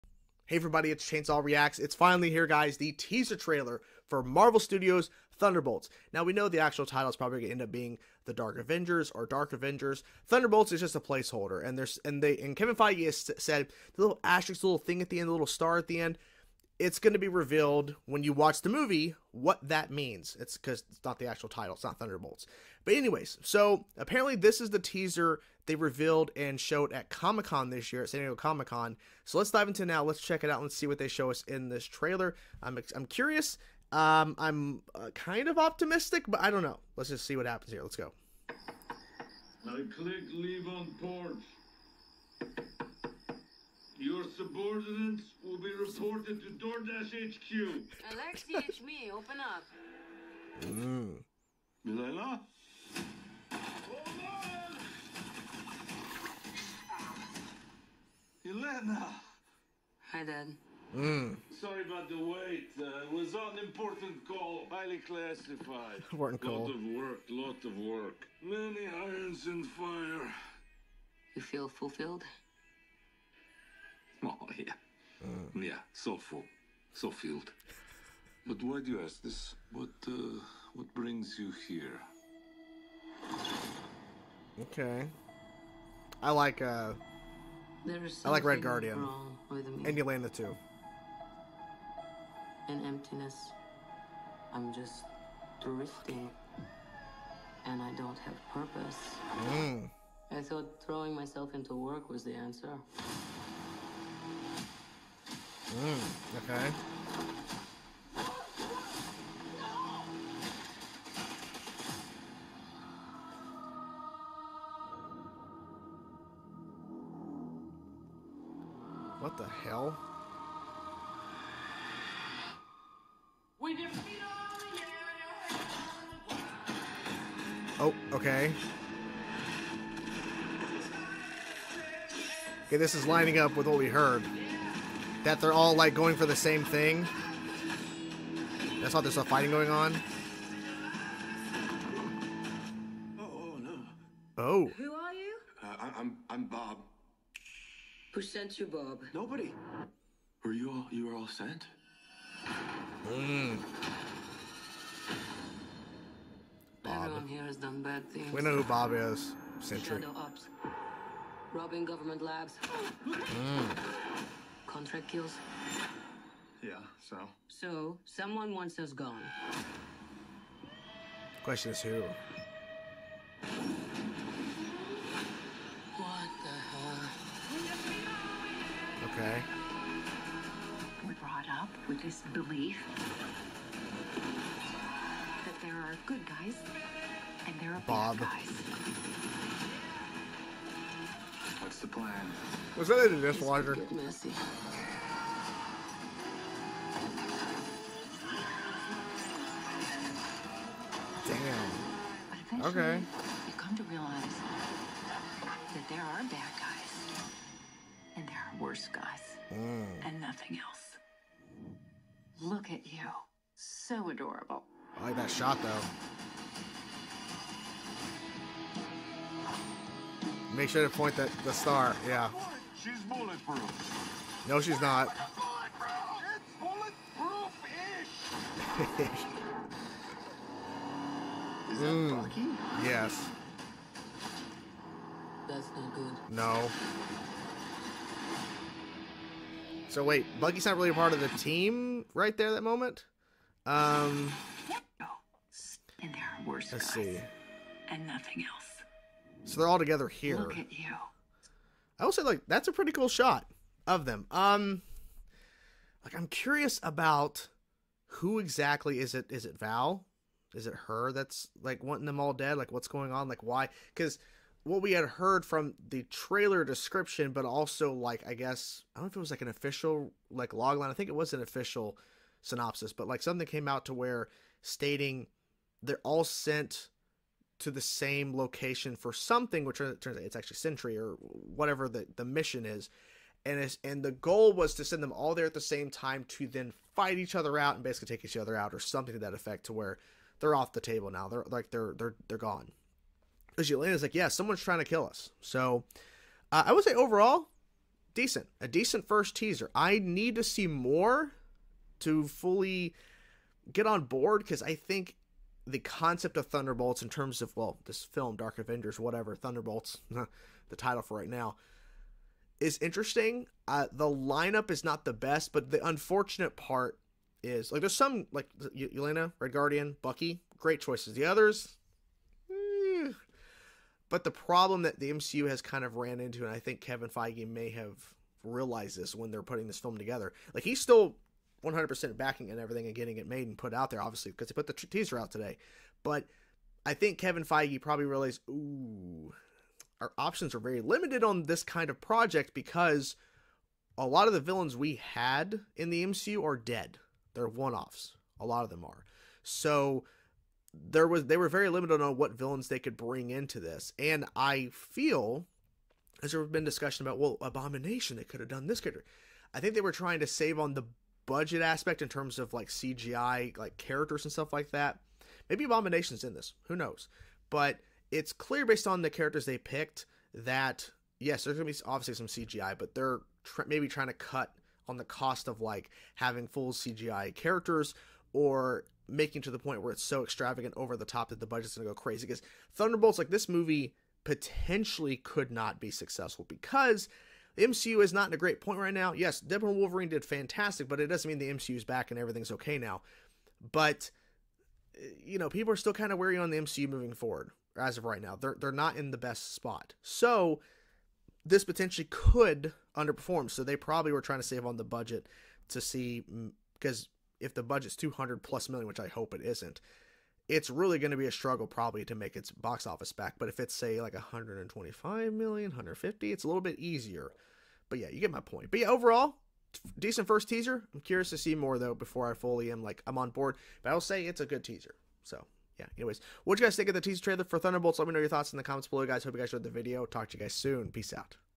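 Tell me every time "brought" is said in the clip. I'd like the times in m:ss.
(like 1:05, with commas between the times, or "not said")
3:01.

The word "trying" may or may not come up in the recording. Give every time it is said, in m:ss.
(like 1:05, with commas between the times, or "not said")
4:54, 5:59, 6:13, 6:44.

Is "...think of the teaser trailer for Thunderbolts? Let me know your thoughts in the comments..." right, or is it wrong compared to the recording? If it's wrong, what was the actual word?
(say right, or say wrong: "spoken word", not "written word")
right.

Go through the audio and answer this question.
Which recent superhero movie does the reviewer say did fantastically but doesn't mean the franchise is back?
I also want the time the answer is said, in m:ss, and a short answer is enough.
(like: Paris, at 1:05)
Deadpool and Wolverine, at 6:29.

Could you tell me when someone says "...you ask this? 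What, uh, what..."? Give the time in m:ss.
1:18.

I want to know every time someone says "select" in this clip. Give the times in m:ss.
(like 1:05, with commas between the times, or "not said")
not said.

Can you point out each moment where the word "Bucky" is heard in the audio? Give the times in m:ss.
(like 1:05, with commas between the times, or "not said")
3:52, 4:00, 5:20.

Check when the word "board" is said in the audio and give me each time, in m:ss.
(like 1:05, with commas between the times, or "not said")
5:04, 7:03.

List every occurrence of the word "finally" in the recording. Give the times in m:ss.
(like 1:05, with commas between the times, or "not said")
0:01.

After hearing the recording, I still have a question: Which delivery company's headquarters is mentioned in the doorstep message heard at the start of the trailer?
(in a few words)
DoorDash.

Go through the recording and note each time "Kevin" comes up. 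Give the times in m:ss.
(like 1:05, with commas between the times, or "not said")
0:12, 5:26, 5:37.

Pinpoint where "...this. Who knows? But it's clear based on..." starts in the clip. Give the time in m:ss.
6:06.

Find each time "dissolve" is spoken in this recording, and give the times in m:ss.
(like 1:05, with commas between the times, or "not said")
not said.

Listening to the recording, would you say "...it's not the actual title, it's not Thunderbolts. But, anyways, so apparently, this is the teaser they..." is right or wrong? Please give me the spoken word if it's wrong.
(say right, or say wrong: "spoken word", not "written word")
right.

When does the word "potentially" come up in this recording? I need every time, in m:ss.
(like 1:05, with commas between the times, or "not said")
6:24, 6:41.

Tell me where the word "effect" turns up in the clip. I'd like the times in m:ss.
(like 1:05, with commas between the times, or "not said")
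4:49.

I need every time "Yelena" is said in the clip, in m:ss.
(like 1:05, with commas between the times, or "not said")
0:58, 4:53, 5:18.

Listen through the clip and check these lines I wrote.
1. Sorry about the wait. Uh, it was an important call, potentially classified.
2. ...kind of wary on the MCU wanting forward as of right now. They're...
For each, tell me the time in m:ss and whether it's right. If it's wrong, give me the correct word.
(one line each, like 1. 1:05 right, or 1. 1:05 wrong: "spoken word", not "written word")
1. 1:01 wrong: "highly", not "potentially"
2. 6:35 wrong: "moving", not "wanting".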